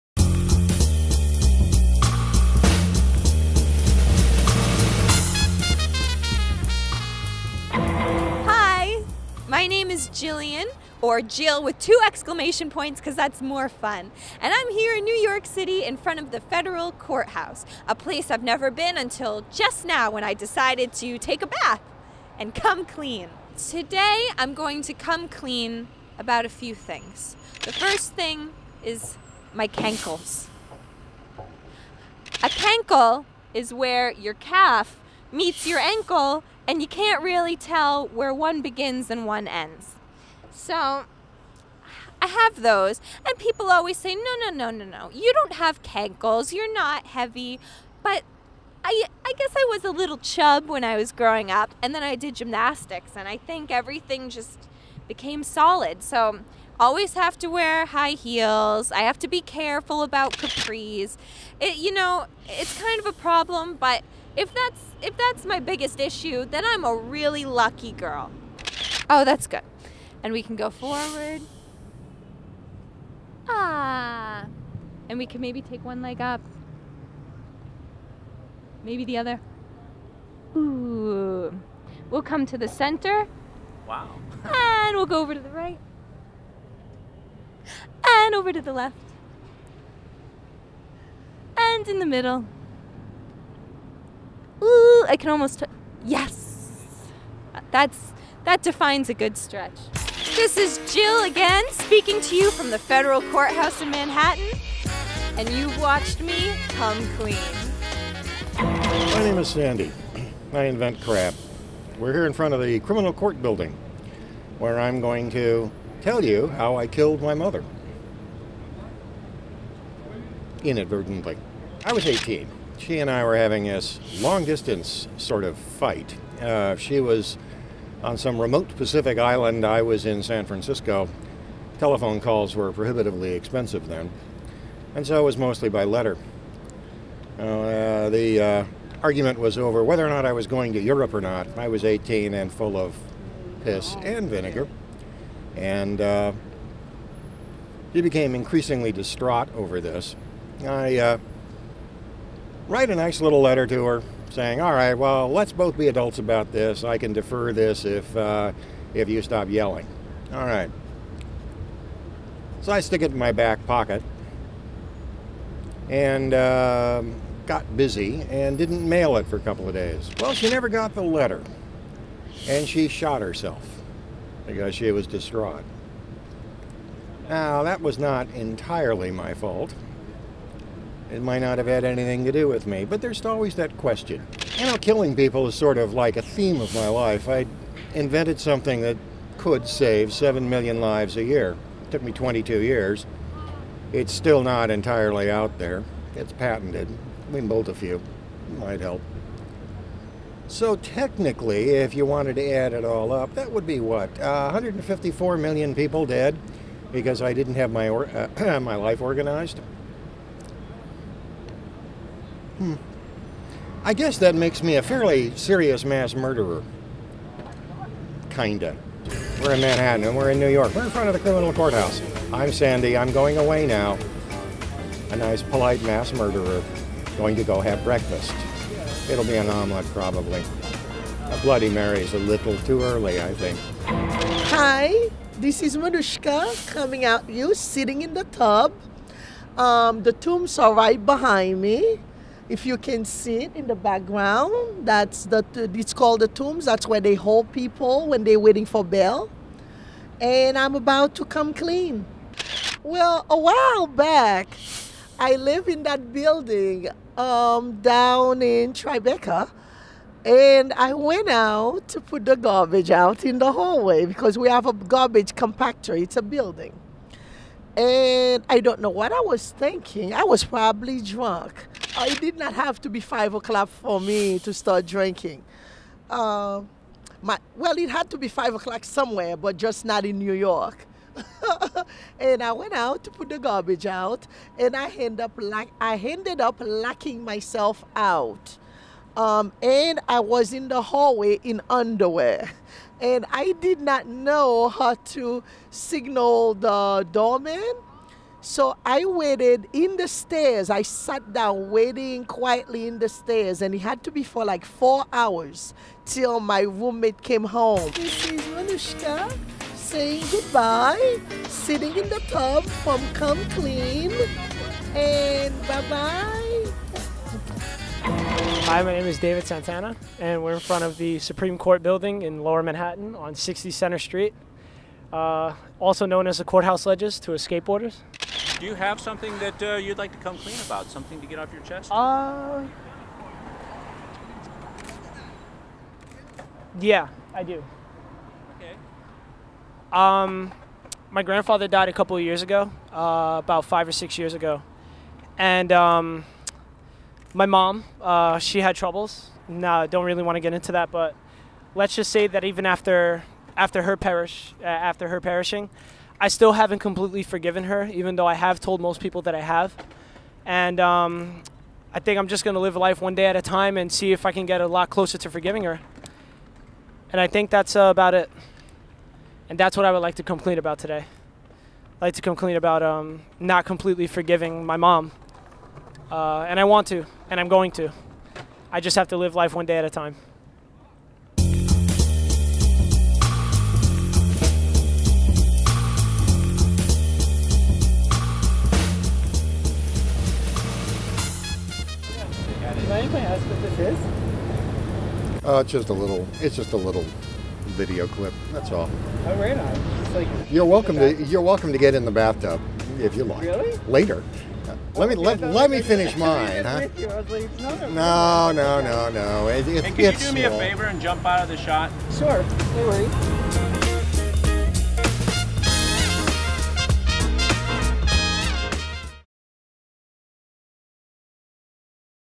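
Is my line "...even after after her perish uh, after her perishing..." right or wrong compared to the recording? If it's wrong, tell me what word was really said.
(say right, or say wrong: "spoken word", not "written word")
right.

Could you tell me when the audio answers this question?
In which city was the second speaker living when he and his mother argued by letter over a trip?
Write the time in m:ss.
2:10.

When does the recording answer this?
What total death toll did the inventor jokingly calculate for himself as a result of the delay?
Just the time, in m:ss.
3:24.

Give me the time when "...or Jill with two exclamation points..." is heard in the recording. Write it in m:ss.
0:11.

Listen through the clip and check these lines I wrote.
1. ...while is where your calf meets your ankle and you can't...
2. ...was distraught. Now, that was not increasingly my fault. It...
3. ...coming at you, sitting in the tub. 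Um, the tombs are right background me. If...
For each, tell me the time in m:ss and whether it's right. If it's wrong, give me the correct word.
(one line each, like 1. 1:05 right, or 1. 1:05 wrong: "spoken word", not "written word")
1. 0:32 wrong: "cankle", not "while"
2. 2:54 wrong: "entirely", not "increasingly"
3. 3:56 wrong: "behind", not "background".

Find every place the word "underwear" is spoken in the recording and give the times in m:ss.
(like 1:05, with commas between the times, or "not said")
4:51.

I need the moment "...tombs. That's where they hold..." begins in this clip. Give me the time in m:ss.
4:06.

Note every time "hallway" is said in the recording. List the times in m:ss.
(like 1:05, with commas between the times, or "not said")
4:23, 4:50.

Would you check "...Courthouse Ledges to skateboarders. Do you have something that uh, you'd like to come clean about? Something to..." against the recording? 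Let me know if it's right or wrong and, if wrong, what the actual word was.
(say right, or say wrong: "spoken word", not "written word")
right.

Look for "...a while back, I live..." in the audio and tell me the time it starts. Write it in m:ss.
4:13.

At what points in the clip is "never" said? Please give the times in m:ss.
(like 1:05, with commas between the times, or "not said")
0:18, 2:50.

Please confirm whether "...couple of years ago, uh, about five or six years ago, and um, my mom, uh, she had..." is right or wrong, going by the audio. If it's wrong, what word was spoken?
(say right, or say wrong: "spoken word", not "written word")
right.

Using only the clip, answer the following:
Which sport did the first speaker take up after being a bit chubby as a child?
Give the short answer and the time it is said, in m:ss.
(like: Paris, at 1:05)
gymnastics, at 0:52.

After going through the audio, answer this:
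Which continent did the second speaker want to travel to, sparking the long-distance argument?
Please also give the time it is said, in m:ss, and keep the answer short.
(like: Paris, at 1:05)
Europe, at 2:20.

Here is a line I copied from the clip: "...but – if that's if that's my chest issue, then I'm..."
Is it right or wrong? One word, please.
wrong.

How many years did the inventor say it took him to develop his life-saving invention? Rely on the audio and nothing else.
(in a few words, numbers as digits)
22.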